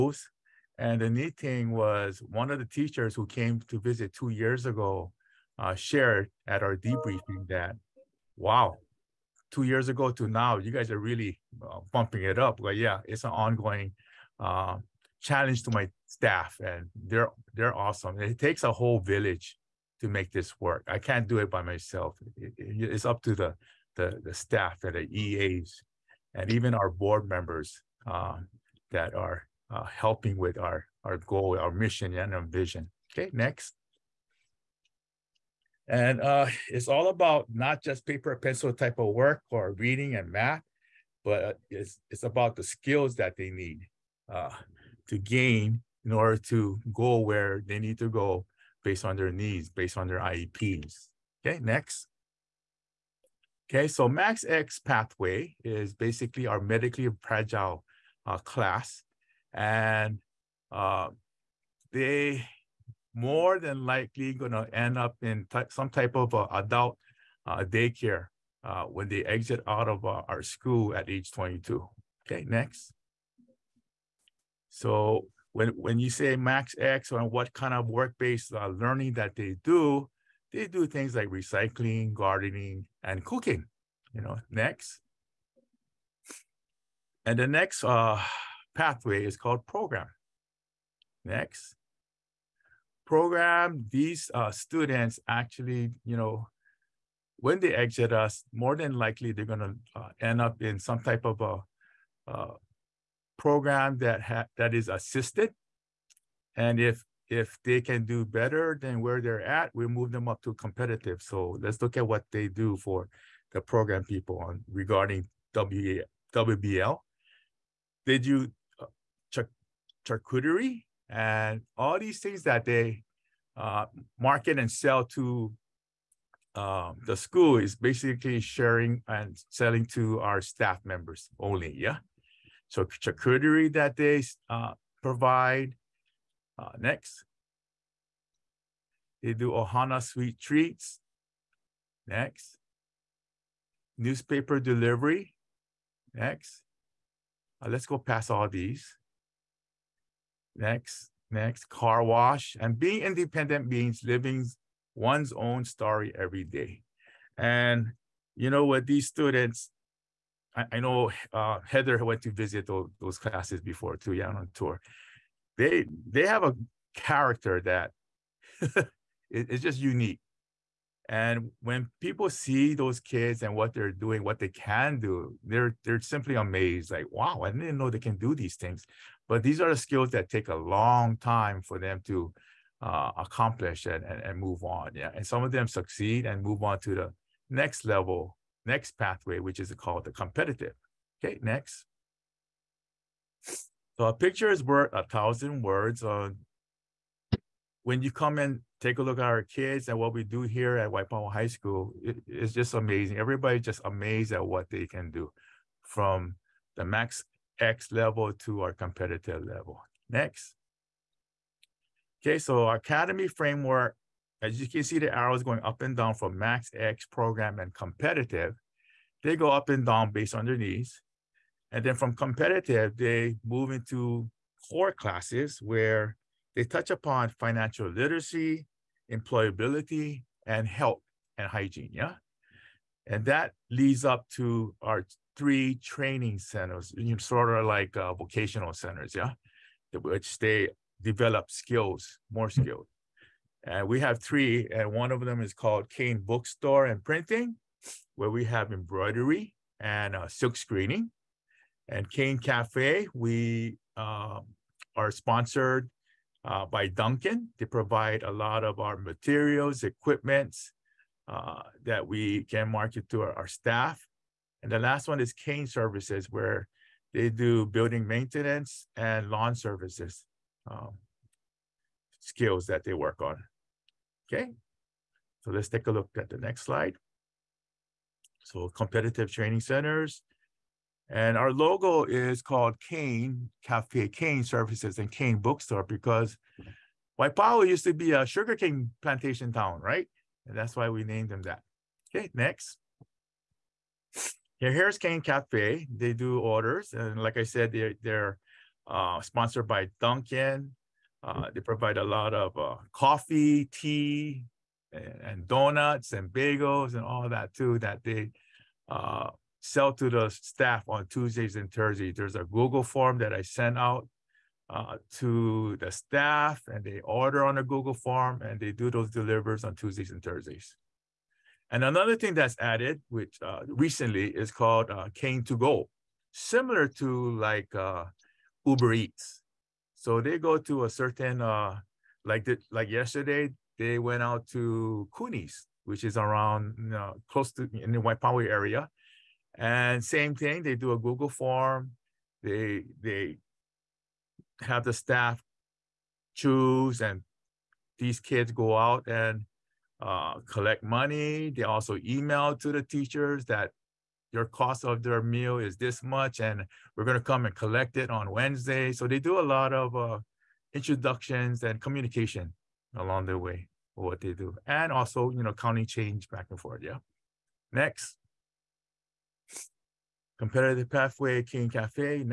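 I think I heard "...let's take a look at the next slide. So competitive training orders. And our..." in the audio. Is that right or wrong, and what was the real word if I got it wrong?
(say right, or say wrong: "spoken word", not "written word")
wrong: "centers", not "orders".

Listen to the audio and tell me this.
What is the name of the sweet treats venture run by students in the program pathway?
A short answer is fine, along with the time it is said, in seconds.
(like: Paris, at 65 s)
Ohana Sweet Treats, at 139 s.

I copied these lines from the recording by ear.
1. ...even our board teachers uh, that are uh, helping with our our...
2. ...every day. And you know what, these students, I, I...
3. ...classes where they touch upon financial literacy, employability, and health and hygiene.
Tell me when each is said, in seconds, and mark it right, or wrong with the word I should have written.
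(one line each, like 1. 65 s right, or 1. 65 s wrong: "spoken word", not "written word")
1. 26 s wrong: "members", not "teachers"
2. 156 s right
3. 224 s right.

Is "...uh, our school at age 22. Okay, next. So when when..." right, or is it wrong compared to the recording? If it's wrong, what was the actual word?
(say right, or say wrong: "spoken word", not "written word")
right.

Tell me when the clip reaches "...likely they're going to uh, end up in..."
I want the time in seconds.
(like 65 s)
98 s.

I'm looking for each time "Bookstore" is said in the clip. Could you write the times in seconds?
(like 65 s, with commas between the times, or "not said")
246 s, 285 s.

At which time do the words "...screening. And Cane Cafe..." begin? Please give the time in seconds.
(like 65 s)
250 s.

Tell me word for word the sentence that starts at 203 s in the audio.
Everybody's just amazed at what they can do from the max X level to our competitive level.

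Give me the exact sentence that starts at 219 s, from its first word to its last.
They go up and down based on their needs.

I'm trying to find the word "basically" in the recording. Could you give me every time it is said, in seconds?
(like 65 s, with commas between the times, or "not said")
55 s, 127 s.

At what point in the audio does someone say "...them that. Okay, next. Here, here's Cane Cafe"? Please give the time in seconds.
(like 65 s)
291 s.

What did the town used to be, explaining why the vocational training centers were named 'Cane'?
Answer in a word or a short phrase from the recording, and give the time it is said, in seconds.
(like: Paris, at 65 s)
A sugarcane plantation town, at 288 s.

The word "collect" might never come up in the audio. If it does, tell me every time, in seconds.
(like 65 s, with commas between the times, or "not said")
350 s, 357 s.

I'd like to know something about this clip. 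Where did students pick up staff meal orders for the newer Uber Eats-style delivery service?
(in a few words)
Kunis.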